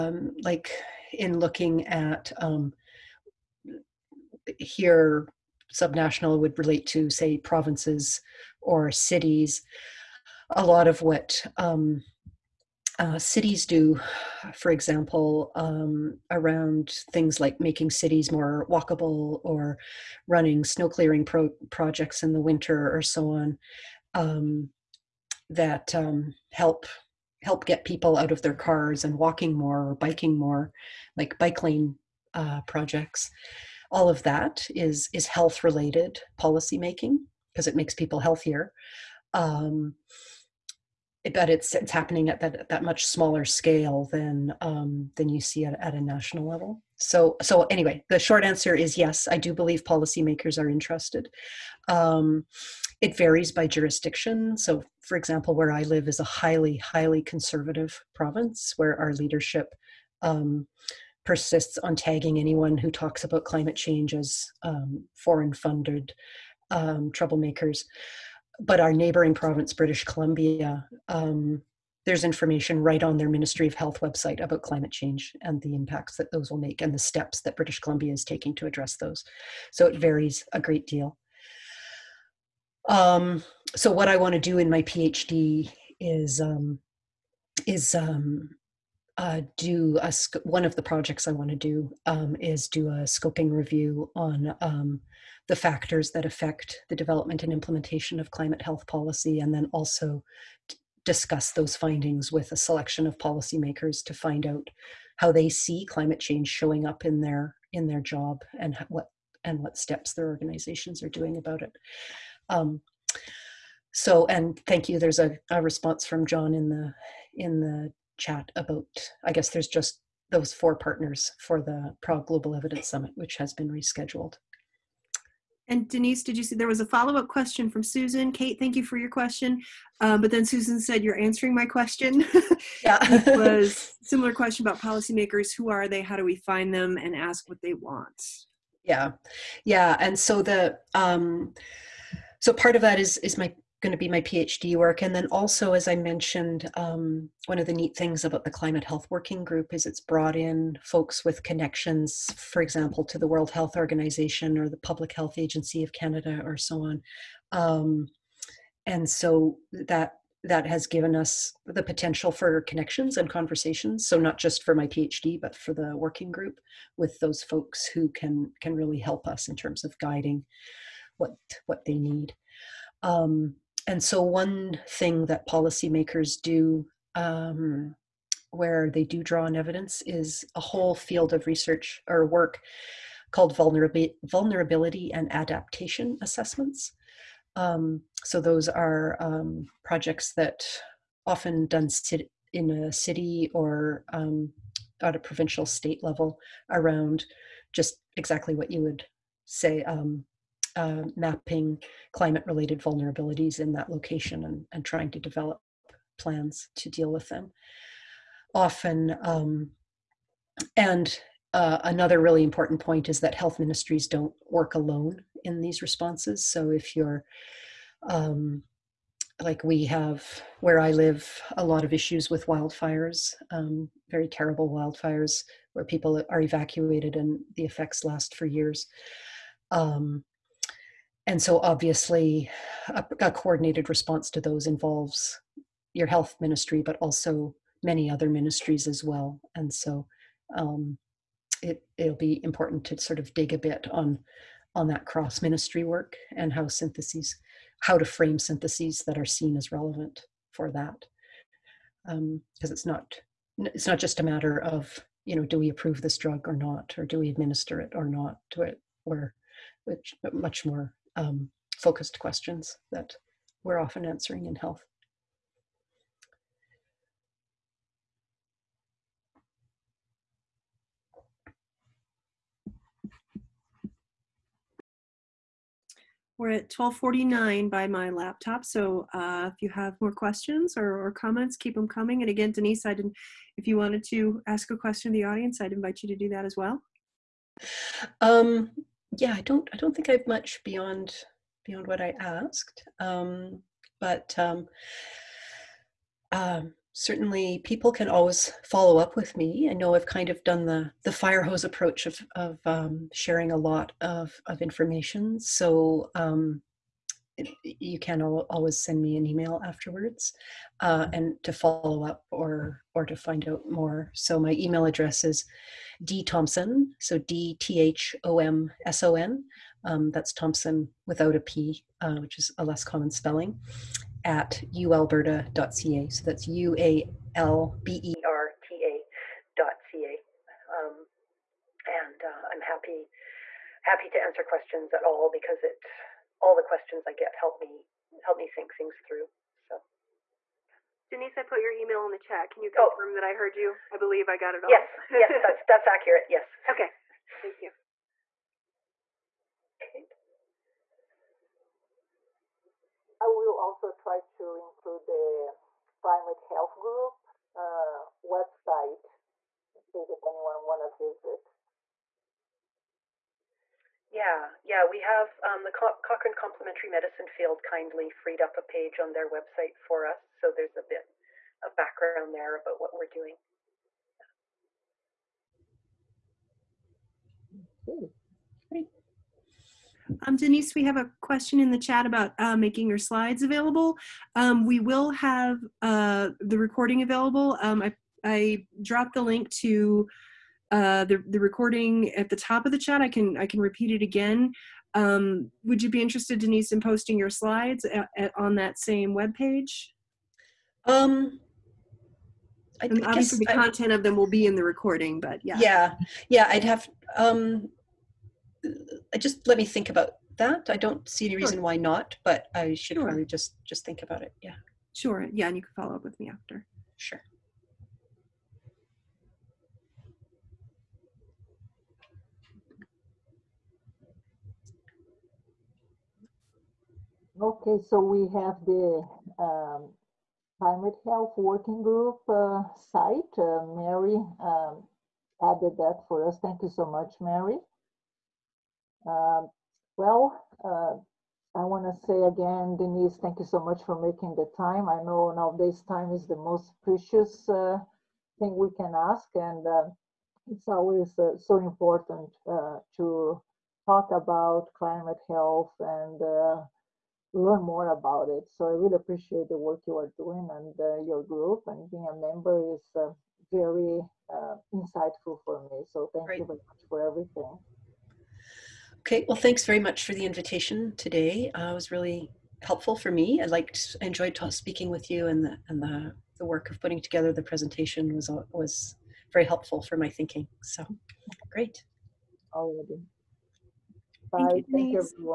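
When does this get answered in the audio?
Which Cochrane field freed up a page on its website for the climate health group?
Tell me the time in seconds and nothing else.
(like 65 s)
366 s.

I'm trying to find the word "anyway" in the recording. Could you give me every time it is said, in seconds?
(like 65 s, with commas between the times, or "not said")
47 s.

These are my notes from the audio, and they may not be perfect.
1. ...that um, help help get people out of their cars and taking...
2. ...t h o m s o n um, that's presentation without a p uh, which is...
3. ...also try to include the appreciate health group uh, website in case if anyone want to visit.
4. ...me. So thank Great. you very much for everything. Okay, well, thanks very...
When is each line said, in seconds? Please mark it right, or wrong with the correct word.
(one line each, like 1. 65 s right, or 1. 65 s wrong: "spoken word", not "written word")
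1. 25 s wrong: "walking", not "taking"
2. 317 s wrong: "thomson", not "presentation"
3. 353 s wrong: "climate", not "appreciate"
4. 465 s right.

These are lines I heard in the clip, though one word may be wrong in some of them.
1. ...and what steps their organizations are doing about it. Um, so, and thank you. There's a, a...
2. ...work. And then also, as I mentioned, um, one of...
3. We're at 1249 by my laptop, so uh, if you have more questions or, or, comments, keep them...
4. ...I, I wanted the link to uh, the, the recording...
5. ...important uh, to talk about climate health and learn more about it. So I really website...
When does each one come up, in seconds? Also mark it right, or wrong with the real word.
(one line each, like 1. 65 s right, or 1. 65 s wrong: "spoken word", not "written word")
1. 109 s right
2. 144 s right
3. 276 s right
4. 387 s wrong: "dropped", not "wanted"
5. 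451 s wrong: "appreciate", not "website".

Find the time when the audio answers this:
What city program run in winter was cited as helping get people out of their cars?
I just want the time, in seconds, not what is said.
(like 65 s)
20 s.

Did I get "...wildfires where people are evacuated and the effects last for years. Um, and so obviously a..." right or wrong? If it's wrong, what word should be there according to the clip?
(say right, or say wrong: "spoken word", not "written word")
right.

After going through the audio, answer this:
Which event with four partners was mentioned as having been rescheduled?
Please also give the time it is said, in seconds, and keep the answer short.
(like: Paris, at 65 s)
Prague Global Evidence Summit, at 122 s.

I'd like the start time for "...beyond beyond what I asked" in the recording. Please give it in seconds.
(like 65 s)
290 s.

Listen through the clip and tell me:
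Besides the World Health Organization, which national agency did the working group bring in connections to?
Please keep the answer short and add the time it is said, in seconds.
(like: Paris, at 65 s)
Public Health Agency of Canada, at 154 s.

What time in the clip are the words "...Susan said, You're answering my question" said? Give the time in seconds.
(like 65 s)
130 s.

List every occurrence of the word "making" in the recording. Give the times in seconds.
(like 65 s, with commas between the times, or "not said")
17 s, 36 s, 382 s, 443 s.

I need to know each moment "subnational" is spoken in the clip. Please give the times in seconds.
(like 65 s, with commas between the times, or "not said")
5 s.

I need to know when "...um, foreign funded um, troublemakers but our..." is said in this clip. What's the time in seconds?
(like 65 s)
64 s.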